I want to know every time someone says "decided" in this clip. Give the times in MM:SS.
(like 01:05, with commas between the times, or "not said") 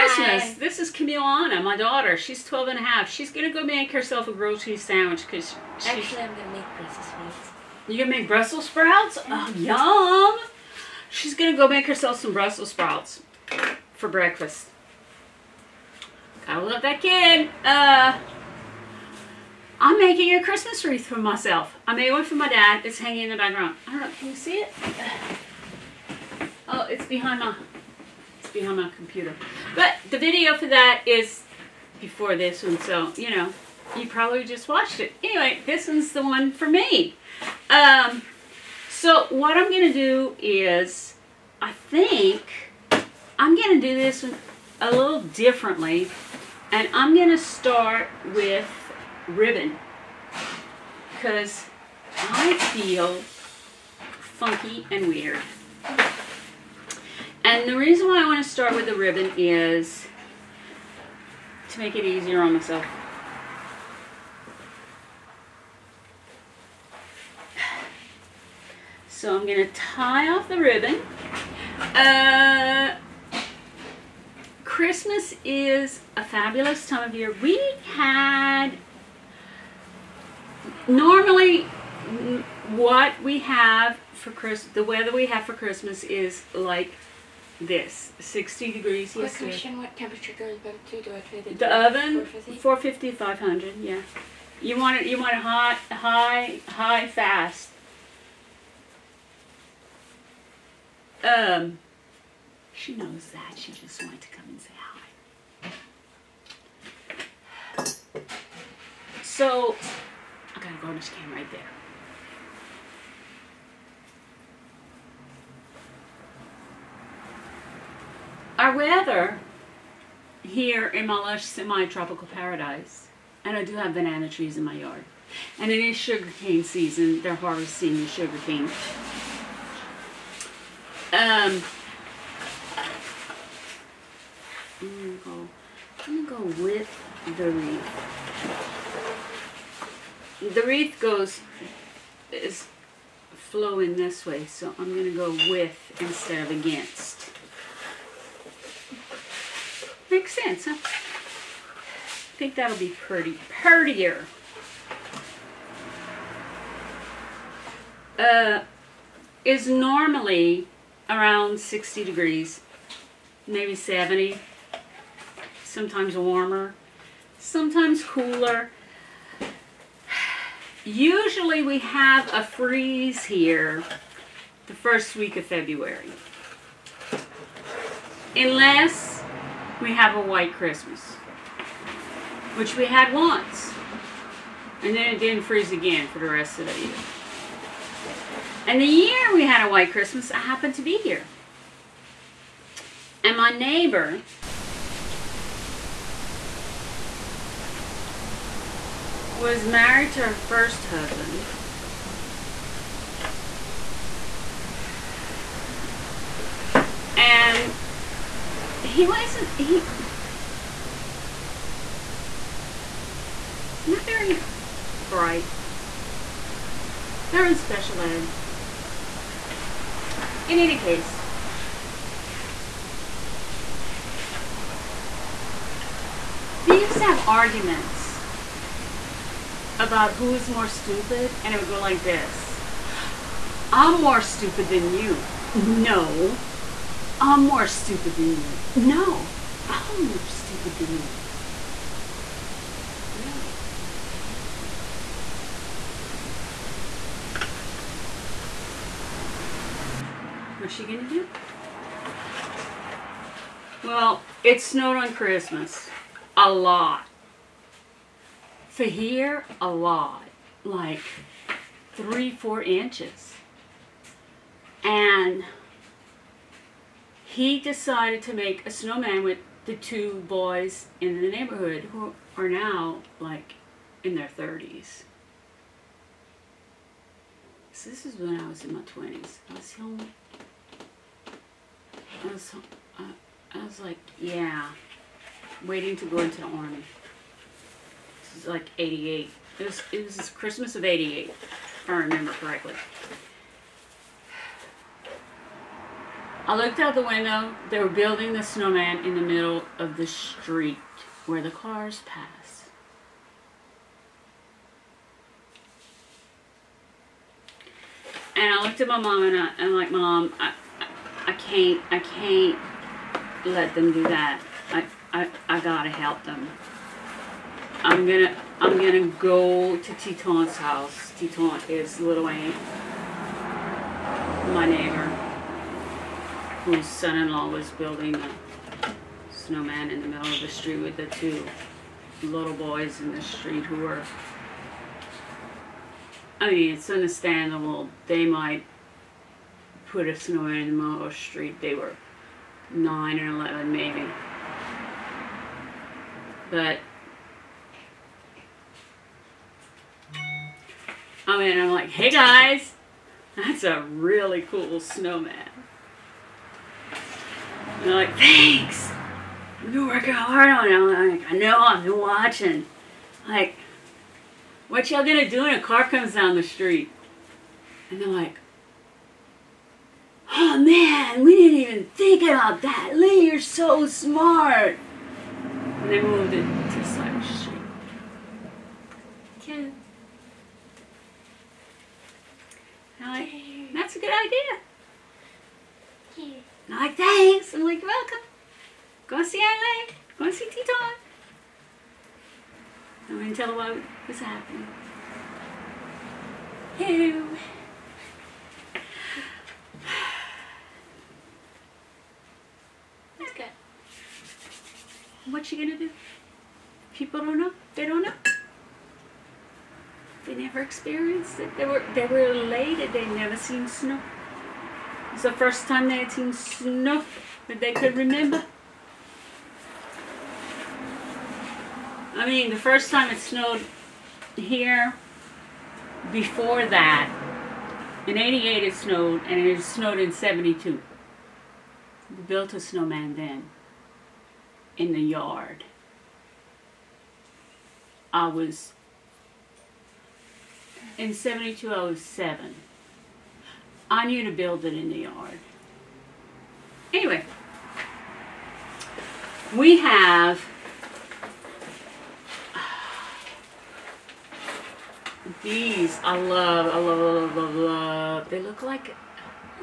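04:27.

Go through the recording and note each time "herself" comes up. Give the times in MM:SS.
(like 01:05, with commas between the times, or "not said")
00:03, 00:11.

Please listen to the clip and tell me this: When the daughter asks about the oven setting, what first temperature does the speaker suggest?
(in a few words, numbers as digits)
450.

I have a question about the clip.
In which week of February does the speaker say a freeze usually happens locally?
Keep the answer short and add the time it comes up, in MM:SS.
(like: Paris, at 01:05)
first week, at 02:54.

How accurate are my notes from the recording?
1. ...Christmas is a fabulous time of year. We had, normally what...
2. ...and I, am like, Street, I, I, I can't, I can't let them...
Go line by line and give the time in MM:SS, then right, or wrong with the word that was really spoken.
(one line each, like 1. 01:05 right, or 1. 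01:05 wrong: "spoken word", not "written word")
1. 01:14 right
2. 05:09 wrong: "Mom", not "Street".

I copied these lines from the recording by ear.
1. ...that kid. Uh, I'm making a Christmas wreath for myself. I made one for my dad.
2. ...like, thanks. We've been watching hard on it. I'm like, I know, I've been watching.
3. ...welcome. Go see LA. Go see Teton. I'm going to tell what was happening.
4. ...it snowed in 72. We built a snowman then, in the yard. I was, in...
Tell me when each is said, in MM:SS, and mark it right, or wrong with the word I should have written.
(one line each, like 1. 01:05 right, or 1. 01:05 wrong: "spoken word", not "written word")
1. 00:16 right
2. 05:57 wrong: "working", not "watching"
3. 06:27 right
4. 07:09 right.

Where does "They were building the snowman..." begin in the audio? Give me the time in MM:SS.
04:57.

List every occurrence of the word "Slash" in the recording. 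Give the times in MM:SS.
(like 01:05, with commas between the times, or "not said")
06:16.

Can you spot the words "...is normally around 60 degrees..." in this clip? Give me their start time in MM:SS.
02:39.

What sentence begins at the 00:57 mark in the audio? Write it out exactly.
And the reason why I want to start with the ribbon is to make it easier on myself.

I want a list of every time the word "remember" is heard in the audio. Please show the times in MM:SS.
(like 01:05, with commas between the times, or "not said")
04:51, 06:57.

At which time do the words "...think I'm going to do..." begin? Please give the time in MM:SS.
00:41.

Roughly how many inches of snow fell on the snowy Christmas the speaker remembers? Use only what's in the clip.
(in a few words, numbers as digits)
3 to 4 inches.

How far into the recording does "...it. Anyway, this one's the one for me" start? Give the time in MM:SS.
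00:34.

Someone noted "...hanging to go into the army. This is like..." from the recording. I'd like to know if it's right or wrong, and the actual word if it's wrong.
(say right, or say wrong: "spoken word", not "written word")
wrong: "waiting", not "hanging".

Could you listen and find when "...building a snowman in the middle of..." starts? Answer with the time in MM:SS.
05:27.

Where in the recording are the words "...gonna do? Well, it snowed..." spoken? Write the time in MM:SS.
04:10.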